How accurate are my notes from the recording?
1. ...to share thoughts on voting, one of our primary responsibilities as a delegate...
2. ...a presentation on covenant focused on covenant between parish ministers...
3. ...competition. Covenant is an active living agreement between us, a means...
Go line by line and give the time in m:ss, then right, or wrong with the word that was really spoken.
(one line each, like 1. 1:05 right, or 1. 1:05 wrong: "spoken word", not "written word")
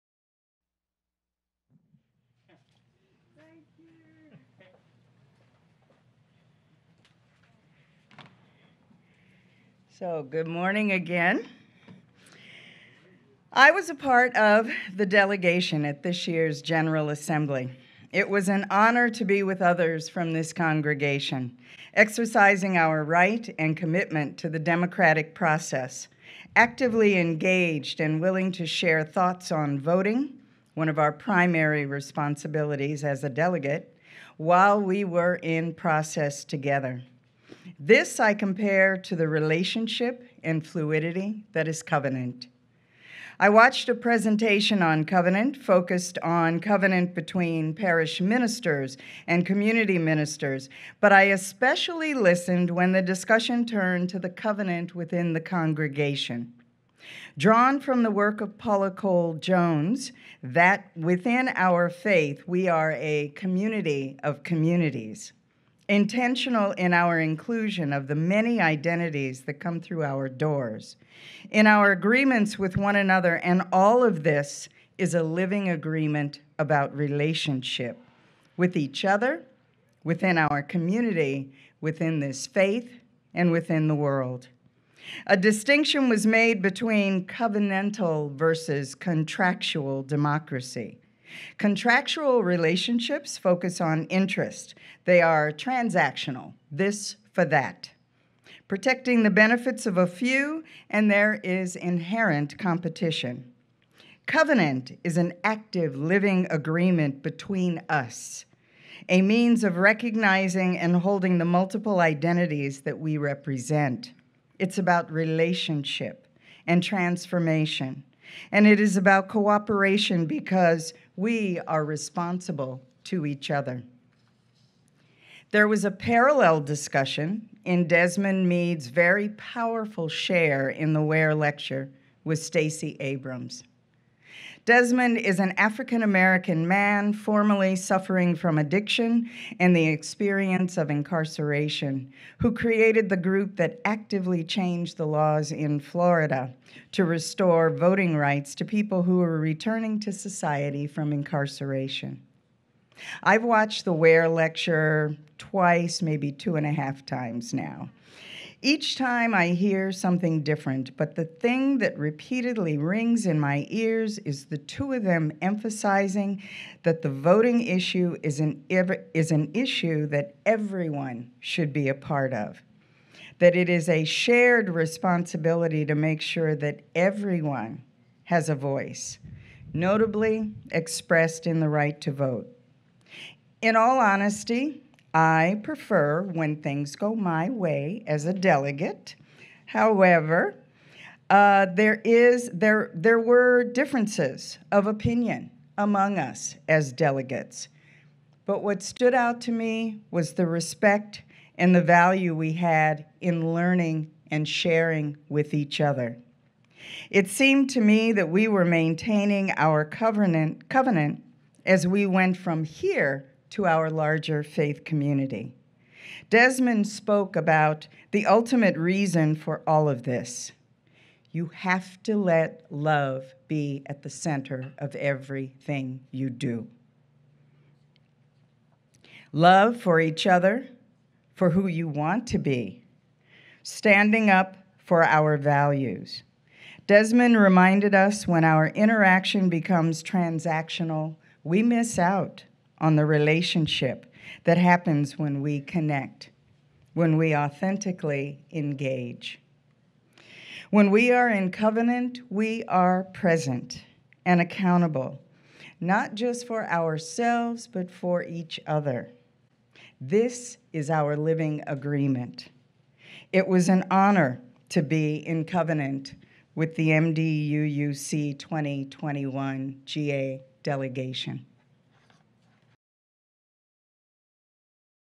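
1. 0:28 right
2. 0:43 right
3. 1:42 right.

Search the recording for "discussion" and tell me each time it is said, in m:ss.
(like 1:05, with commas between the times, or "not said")
0:53, 2:06.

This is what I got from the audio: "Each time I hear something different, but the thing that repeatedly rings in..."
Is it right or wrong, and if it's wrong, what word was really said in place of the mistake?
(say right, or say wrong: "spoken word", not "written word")
right.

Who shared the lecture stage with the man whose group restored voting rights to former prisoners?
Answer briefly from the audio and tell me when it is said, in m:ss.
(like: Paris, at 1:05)
Stacey Abrams, at 2:12.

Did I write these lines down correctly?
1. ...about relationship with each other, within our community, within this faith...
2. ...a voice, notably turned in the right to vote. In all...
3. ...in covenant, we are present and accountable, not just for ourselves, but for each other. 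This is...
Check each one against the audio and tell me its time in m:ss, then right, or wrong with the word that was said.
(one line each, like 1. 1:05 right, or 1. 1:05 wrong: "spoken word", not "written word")
1. 1:16 right
2. 2:58 wrong: "expressed", not "turned"
3. 4:11 right.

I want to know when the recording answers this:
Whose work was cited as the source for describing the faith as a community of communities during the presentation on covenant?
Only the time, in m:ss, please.
0:58.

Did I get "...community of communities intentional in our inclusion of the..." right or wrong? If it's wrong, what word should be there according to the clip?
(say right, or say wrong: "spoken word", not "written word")
right.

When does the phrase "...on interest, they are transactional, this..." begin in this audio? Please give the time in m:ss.
1:33.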